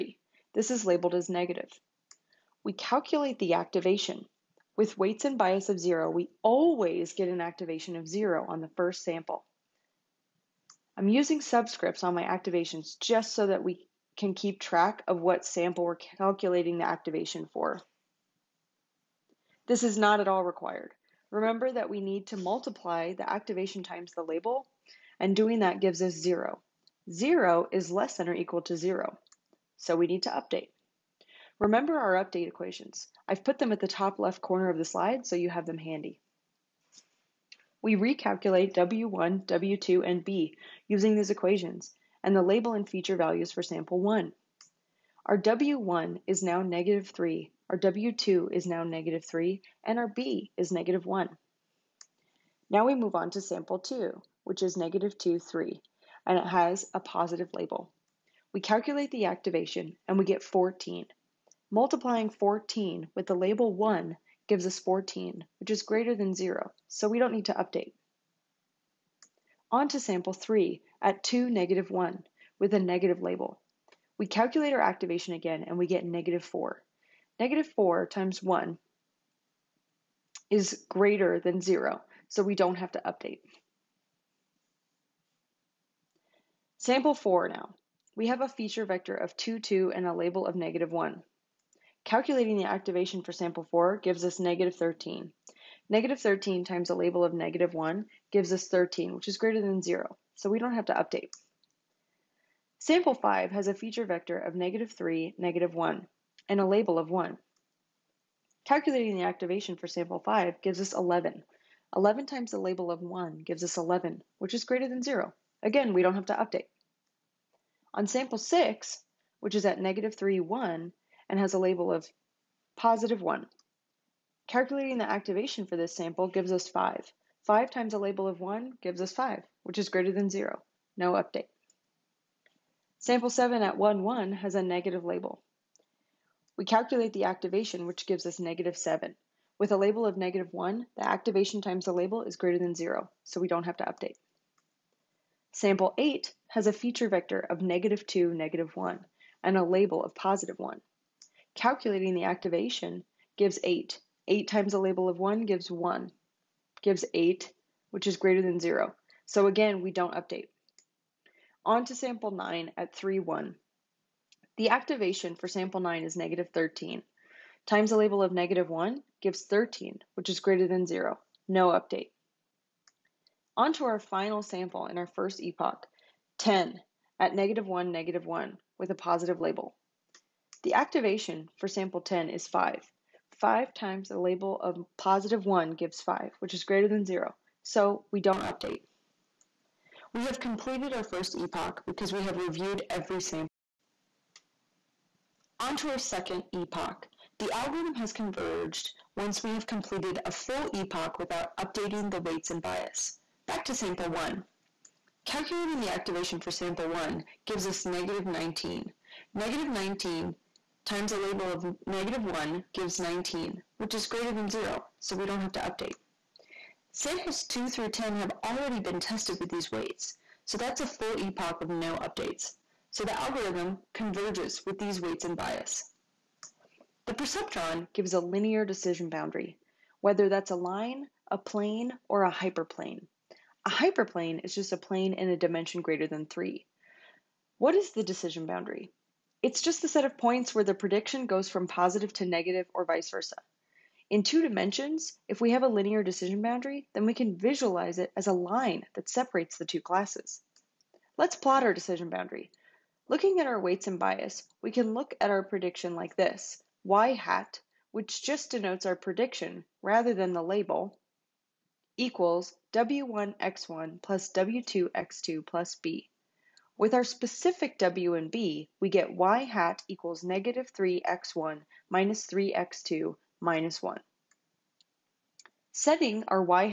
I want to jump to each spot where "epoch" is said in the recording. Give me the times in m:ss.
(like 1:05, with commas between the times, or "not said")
2:55, 3:11, 3:16, 3:20, 3:41.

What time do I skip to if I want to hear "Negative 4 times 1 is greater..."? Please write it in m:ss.
1:17.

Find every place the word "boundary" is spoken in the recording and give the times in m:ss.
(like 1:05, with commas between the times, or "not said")
3:49, 3:58, 4:06, 4:12.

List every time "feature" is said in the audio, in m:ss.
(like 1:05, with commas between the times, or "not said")
0:42, 1:28, 1:43, 2:26.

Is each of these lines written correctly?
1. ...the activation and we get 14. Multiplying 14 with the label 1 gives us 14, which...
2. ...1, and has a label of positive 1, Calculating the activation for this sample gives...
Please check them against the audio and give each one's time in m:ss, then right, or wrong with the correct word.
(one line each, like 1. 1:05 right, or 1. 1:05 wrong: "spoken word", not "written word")
1. 0:59 right
2. 2:00 right.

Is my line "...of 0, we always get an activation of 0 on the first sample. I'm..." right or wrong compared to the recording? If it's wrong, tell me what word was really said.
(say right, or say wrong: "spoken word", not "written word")
right.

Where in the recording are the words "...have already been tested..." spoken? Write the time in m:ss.
3:38.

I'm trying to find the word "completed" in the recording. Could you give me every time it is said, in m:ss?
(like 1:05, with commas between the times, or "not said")
3:10, 3:19.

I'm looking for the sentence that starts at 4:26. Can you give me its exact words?
With our specific W and B, we get y hat equals negative 3x1 minus 3x2 minus 1.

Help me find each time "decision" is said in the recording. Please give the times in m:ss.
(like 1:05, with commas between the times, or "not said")
3:48, 3:58, 4:06, 4:11.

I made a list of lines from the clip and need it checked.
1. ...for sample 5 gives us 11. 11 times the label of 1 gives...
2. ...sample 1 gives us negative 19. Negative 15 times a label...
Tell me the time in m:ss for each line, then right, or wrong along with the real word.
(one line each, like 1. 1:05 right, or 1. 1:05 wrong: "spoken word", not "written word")
1. 1:49 right
2. 3:26 wrong: "19", not "15".